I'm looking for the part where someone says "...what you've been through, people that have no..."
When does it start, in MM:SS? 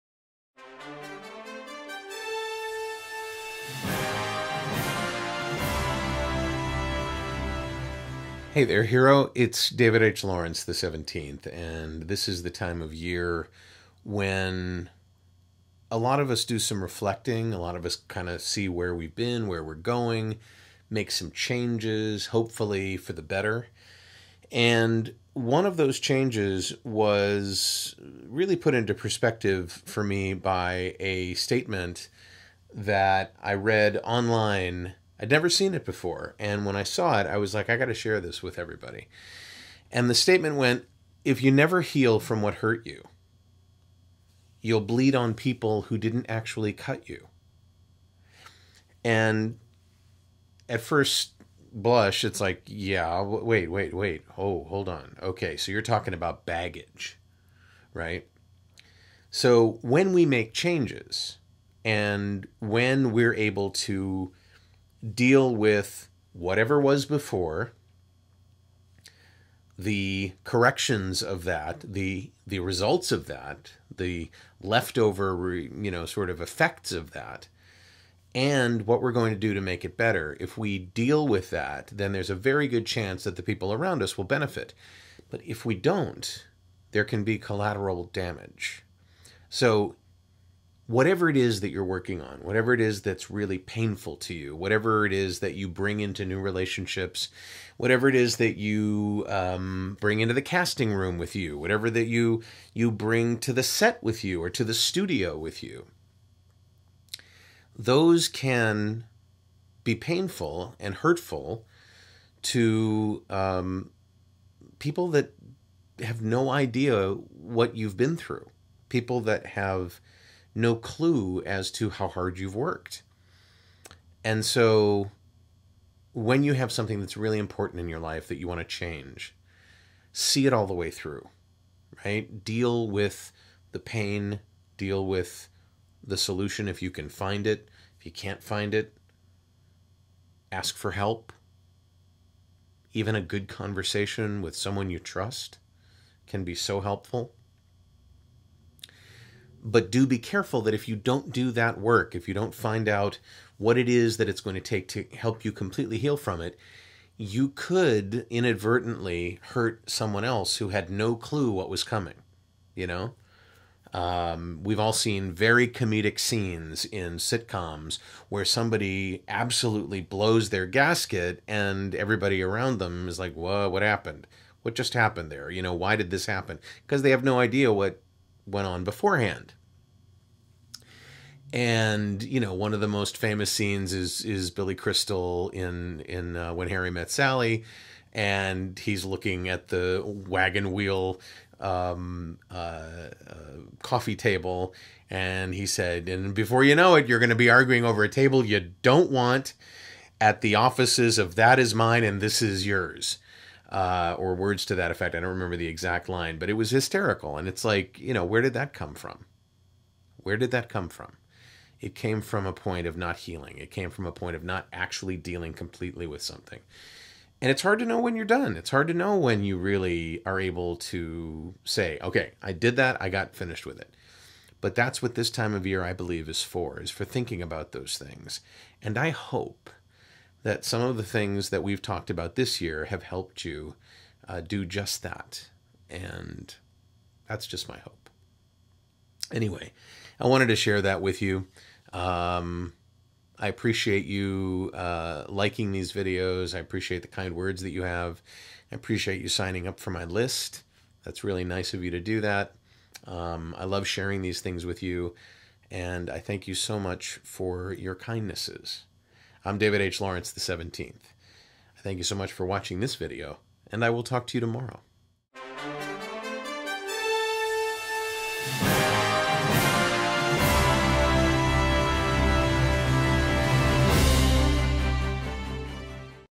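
01:57.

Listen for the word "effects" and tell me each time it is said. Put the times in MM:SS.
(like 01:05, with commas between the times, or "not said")
01:16, 03:24.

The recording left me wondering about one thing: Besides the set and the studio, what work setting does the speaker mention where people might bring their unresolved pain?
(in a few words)
casting room.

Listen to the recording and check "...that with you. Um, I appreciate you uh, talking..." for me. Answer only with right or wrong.
wrong.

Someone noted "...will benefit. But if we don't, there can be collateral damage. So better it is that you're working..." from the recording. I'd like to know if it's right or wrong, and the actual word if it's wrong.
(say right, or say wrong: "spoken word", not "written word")
wrong: "whatever", not "better".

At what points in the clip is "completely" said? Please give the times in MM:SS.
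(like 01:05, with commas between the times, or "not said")
02:35, 03:35.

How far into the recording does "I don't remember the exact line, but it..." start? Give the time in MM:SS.
03:25.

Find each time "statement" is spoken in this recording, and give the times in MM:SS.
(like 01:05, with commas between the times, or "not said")
00:31, 00:40.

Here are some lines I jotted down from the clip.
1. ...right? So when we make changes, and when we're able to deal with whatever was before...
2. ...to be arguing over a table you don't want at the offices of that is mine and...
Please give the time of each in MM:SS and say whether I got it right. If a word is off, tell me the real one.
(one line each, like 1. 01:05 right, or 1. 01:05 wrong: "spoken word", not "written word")
1. 00:57 right
2. 03:17 right.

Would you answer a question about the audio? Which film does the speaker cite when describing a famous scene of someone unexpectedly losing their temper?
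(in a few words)
When Harry Met Sally.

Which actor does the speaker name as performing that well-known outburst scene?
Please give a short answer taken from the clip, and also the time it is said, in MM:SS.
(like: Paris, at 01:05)
Billy Crystal, at 03:04.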